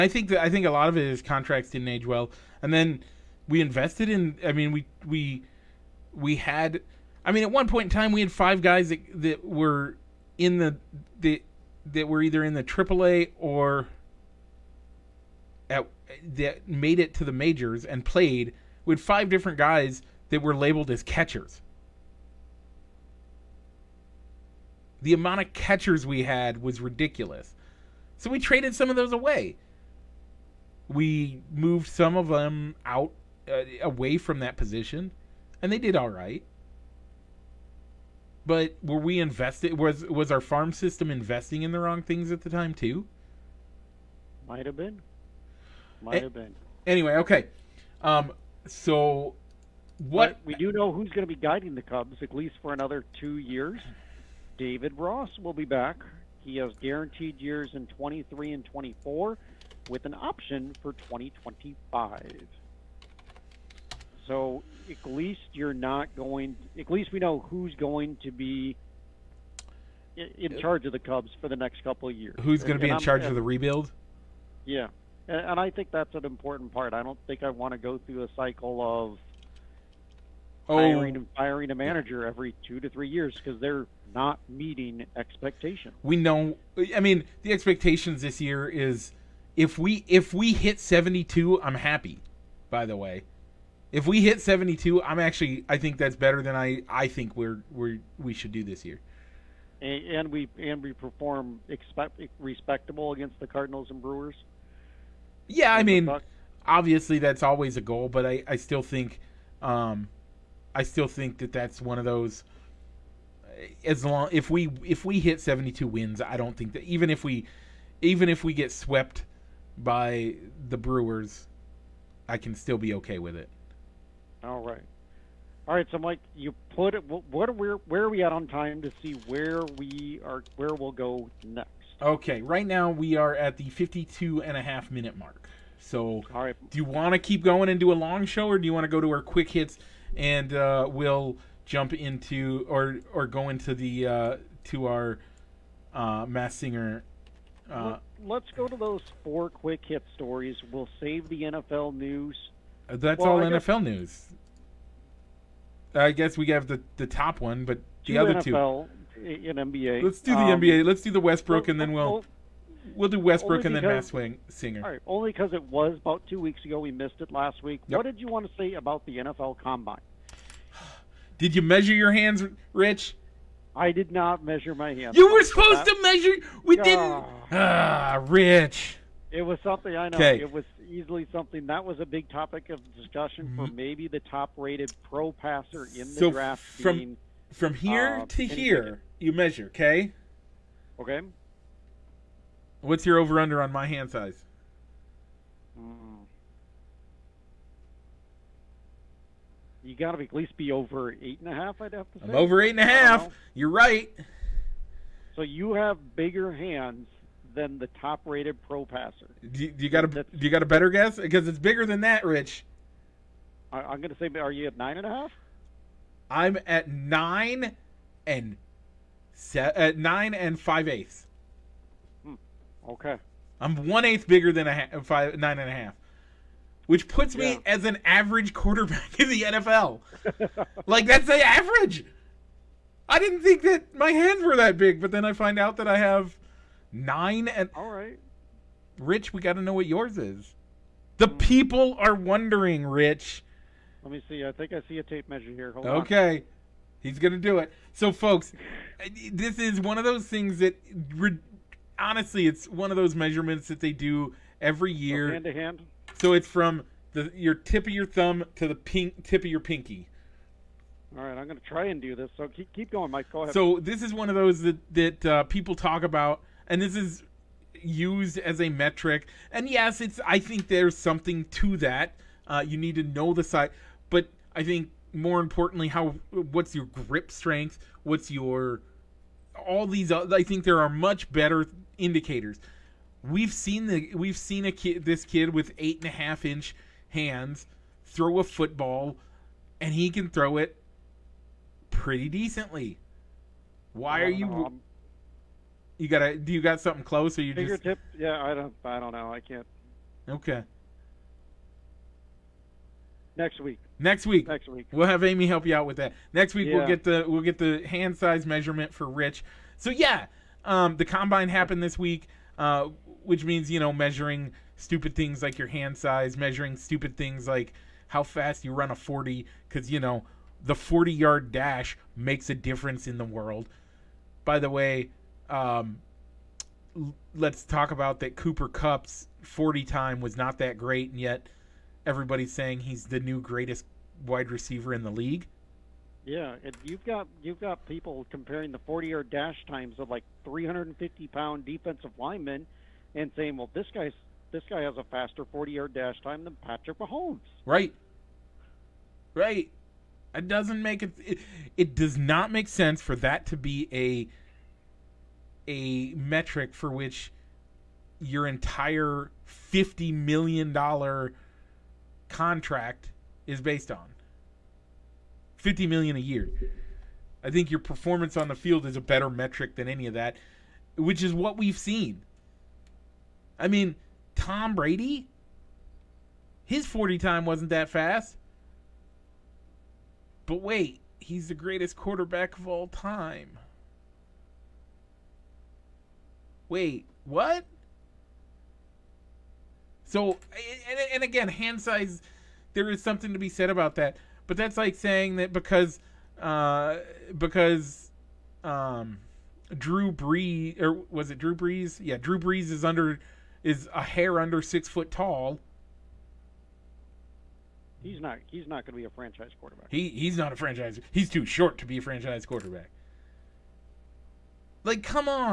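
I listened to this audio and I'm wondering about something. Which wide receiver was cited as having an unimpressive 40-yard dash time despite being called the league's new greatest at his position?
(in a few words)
Cooper Kupp.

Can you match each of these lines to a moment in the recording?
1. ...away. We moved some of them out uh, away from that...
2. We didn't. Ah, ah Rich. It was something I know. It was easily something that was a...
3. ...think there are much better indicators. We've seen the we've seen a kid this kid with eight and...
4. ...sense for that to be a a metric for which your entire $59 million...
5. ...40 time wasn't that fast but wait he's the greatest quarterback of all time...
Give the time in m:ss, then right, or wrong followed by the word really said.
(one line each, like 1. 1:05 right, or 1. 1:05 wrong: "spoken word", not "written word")
1. 0:29 right
2. 2:56 right
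3. 4:40 right
4. 5:52 wrong: "50", not "59"
5. 6:16 right.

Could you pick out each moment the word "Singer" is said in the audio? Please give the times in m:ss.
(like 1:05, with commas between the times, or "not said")
2:26, 2:44.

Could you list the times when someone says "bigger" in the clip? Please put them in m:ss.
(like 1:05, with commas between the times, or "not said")
3:26, 3:31, 3:44.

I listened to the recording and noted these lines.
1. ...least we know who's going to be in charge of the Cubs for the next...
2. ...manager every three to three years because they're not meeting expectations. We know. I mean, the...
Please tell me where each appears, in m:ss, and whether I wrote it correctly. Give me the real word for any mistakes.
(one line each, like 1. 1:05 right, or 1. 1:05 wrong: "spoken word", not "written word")
1. 1:06 right
2. 1:21 wrong: "two", not "three".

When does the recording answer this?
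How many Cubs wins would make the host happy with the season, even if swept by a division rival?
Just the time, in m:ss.
1:55.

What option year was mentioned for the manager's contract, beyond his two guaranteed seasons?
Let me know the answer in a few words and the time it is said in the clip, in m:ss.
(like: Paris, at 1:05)
2025, at 1:00.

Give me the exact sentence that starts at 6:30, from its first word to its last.
So, and, and again, hand size, there is something to be said about that.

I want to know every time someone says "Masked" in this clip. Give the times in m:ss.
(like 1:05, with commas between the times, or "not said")
2:26, 2:43.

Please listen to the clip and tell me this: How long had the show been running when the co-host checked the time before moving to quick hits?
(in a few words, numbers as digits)
52 and a half minutes.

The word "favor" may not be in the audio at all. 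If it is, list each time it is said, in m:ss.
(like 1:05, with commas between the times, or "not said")
not said.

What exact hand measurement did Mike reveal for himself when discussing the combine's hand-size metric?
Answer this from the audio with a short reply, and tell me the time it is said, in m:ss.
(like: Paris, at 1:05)
9 5/8 inches, at 3:39.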